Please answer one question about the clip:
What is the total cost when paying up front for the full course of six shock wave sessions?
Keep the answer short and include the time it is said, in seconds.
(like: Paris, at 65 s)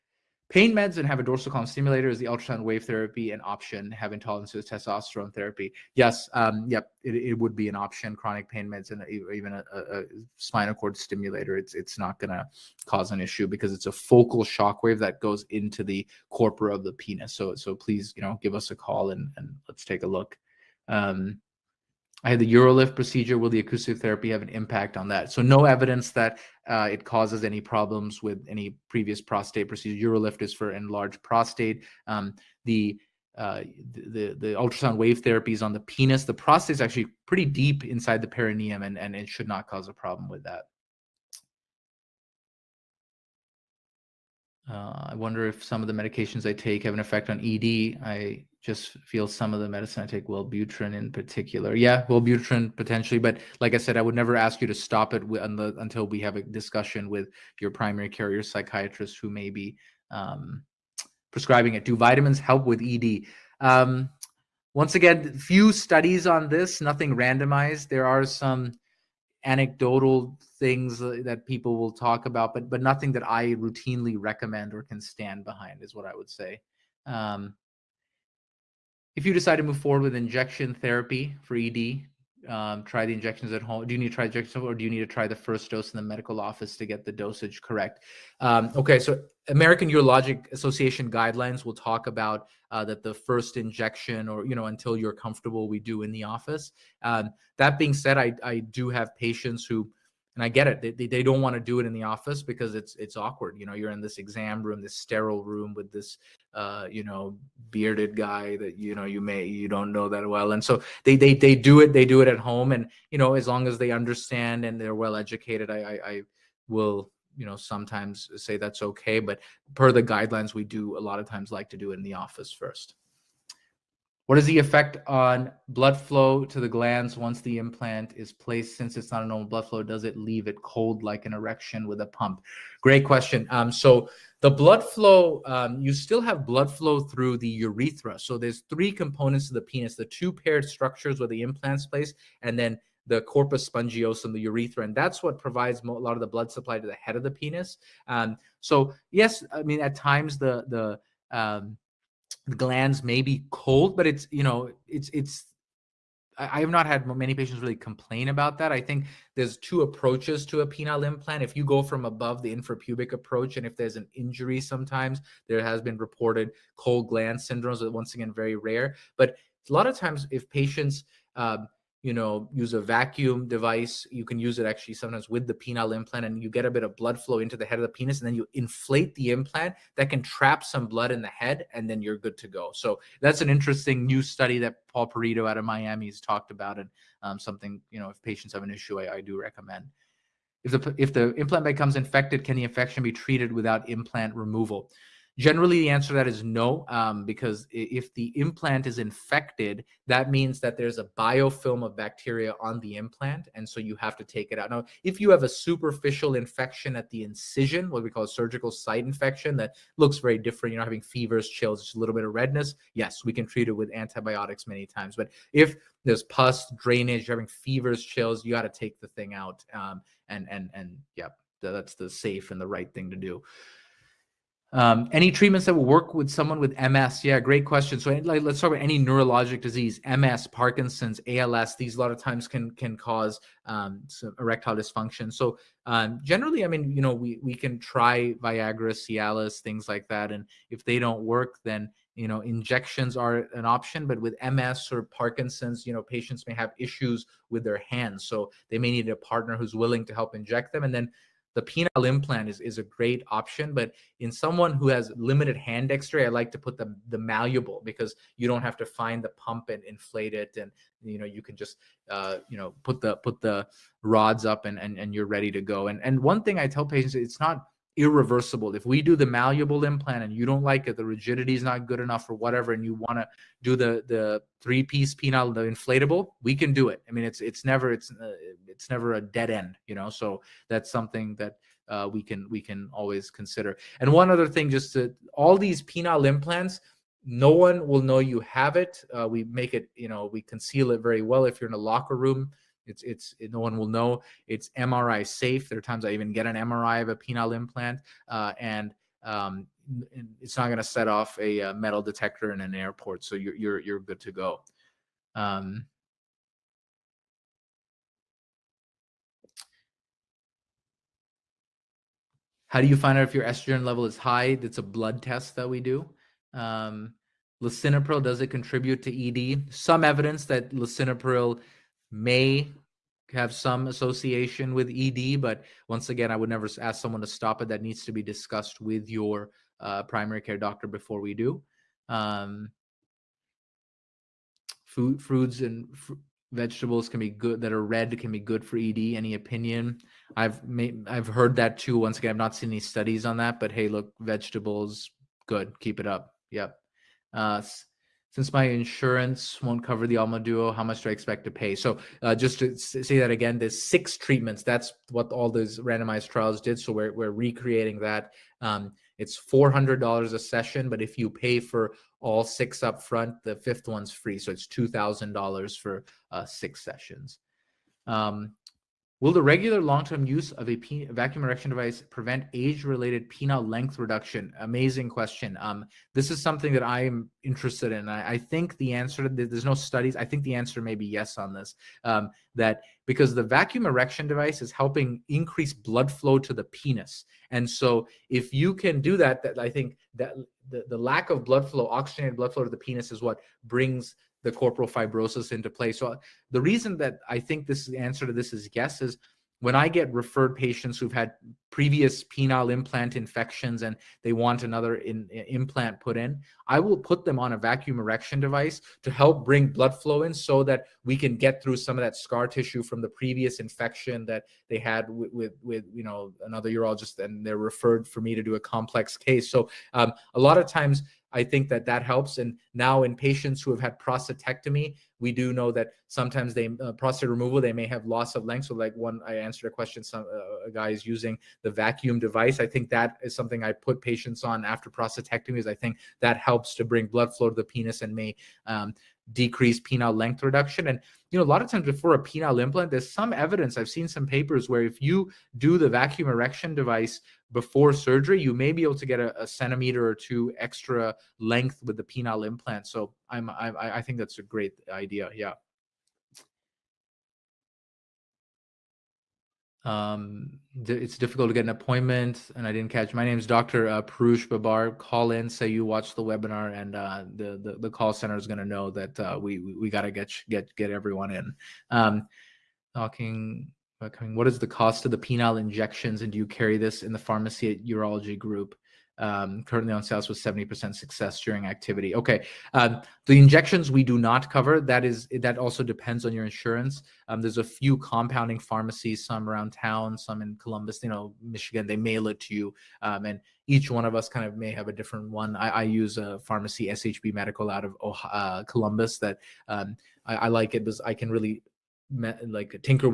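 $2,000, at 364 s.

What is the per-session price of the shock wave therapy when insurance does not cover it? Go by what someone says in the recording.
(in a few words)
$400.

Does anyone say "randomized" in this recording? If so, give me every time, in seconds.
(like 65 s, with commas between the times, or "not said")
67 s, 355 s.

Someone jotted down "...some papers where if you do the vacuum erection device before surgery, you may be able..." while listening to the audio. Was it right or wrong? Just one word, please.
right.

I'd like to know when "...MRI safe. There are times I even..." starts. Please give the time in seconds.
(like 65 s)
294 s.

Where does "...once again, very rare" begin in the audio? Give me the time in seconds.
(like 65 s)
167 s.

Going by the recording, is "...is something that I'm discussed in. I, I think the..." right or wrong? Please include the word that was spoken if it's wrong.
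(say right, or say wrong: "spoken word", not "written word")
wrong: "interested", not "discussed".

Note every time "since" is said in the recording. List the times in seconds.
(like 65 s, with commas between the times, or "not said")
128 s, 348 s.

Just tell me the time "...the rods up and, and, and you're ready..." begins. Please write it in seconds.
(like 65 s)
263 s.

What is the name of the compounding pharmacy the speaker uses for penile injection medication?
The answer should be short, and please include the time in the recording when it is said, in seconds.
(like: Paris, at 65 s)
SHB Medical, at 496 s.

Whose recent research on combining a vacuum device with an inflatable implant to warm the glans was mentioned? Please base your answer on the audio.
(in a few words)
Paul Perito.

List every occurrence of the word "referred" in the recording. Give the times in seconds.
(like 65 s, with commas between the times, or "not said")
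400 s, 417 s.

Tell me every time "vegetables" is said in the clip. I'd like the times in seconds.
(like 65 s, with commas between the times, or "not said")
336 s, 344 s.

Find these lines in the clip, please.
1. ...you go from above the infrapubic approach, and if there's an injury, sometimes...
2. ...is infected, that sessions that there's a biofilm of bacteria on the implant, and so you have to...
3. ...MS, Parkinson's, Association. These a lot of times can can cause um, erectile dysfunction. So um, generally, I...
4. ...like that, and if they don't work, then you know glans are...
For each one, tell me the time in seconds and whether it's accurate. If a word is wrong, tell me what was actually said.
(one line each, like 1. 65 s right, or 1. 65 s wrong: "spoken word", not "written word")
1. 161 s right
2. 198 s wrong: "means", not "sessions"
3. 230 s wrong: "ALS", not "Association"
4. 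239 s wrong: "injections", not "glans".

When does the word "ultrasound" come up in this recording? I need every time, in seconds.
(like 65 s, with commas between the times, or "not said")
2 s, 34 s.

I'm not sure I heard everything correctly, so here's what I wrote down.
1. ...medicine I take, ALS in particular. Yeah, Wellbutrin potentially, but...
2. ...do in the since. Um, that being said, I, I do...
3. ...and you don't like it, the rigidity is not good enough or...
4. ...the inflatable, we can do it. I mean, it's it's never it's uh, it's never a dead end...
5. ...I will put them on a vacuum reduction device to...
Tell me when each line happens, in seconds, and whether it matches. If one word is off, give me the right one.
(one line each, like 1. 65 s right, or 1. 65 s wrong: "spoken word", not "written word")
1. 49 s wrong: "Wellbutrin", not "ALS"
2. 95 s wrong: "office", not "since"
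3. 270 s right
4. 275 s right
5. 406 s wrong: "erection", not "reduction".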